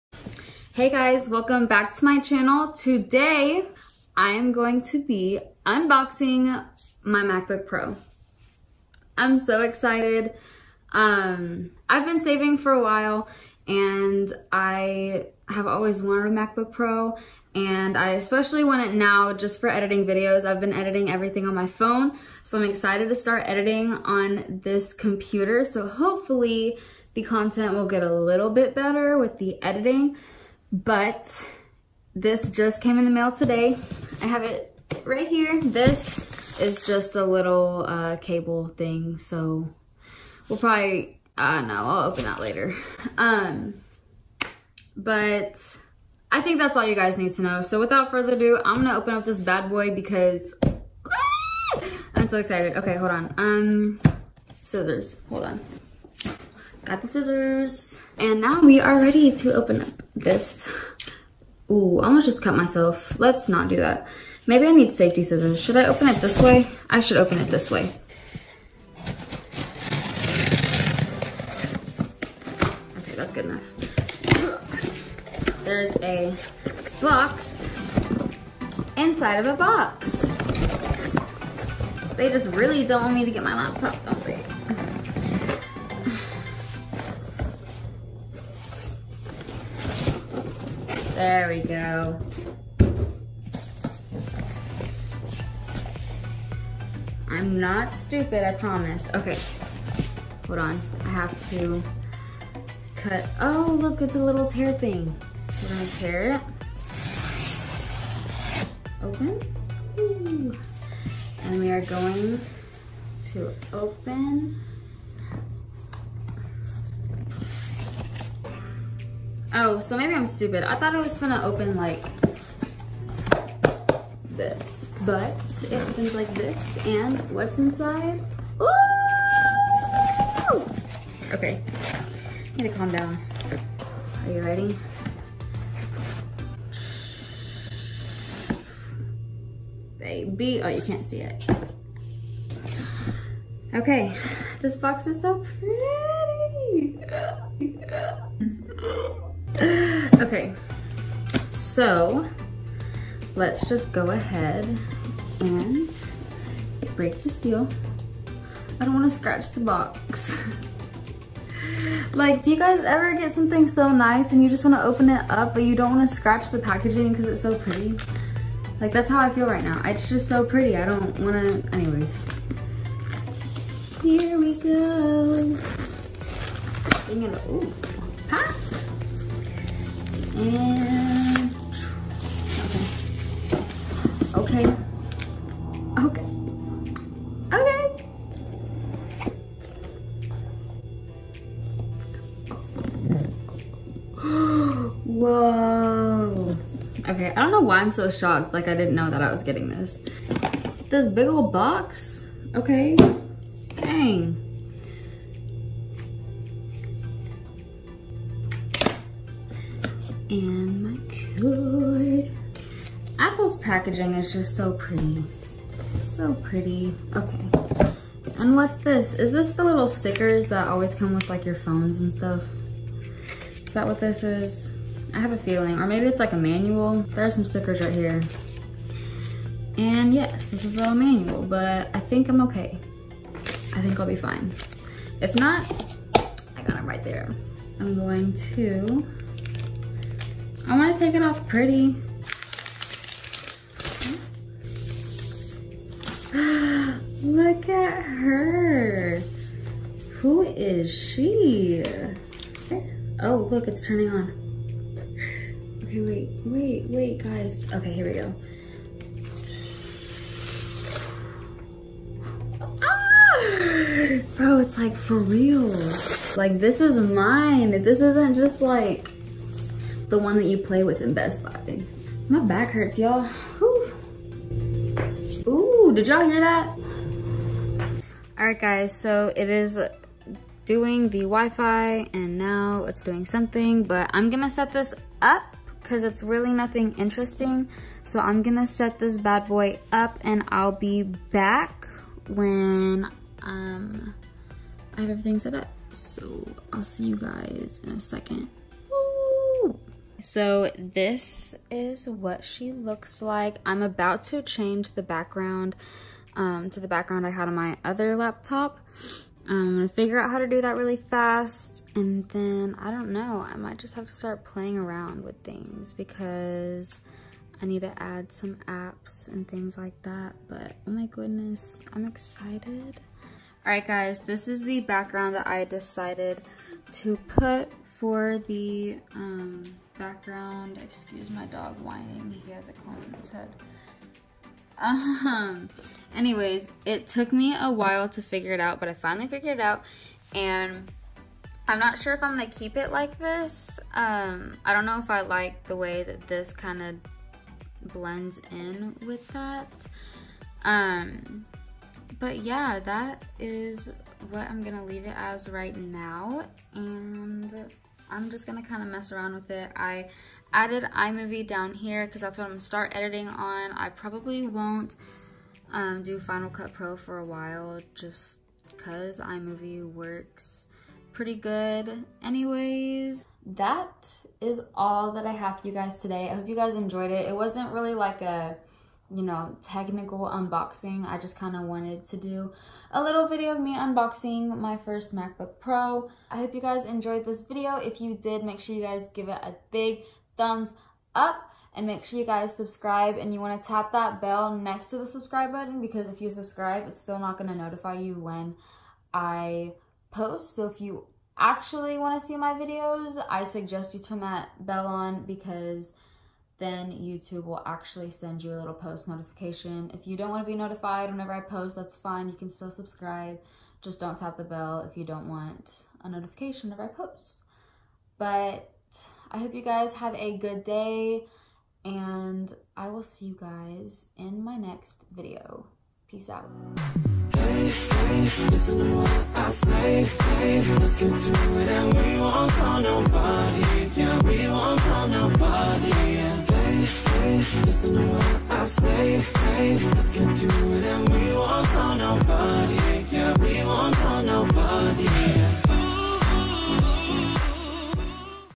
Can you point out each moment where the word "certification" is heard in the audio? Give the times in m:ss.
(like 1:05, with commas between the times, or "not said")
not said.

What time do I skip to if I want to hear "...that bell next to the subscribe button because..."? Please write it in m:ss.
6:33.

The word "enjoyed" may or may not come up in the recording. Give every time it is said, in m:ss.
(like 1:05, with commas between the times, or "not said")
6:16, 6:26.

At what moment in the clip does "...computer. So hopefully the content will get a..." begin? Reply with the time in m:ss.
0:24.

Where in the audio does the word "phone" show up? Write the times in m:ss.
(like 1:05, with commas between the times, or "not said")
0:21, 3:41.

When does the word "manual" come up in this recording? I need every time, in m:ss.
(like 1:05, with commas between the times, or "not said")
3:46, 3:50.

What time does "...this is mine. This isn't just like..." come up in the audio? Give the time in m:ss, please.
4:26.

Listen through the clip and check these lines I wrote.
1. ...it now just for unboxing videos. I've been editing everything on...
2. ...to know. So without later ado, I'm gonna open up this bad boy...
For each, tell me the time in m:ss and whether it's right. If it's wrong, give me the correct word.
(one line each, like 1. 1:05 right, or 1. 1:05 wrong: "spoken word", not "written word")
1. 0:18 wrong: "editing", not "unboxing"
2. 0:47 wrong: "further", not "later".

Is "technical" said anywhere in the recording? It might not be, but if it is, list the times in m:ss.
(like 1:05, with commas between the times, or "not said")
6:19.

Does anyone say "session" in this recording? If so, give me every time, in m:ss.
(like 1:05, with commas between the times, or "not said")
not said.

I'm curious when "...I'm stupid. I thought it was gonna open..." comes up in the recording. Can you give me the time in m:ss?
2:00.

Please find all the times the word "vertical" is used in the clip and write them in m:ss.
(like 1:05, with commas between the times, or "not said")
not said.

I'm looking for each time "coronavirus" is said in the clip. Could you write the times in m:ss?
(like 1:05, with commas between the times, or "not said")
not said.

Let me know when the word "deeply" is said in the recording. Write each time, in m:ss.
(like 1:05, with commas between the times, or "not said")
not said.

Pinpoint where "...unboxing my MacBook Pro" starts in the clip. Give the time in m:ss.
0:05.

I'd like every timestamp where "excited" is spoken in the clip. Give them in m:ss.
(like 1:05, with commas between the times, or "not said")
0:09, 0:22, 0:52, 5:22.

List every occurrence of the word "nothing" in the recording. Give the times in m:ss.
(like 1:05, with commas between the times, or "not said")
4:46.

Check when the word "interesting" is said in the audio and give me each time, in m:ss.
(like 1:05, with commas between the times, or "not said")
4:46.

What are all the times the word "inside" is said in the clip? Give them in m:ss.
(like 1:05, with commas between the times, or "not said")
1:18, 2:07.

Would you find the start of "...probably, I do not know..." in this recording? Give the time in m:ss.
0:40.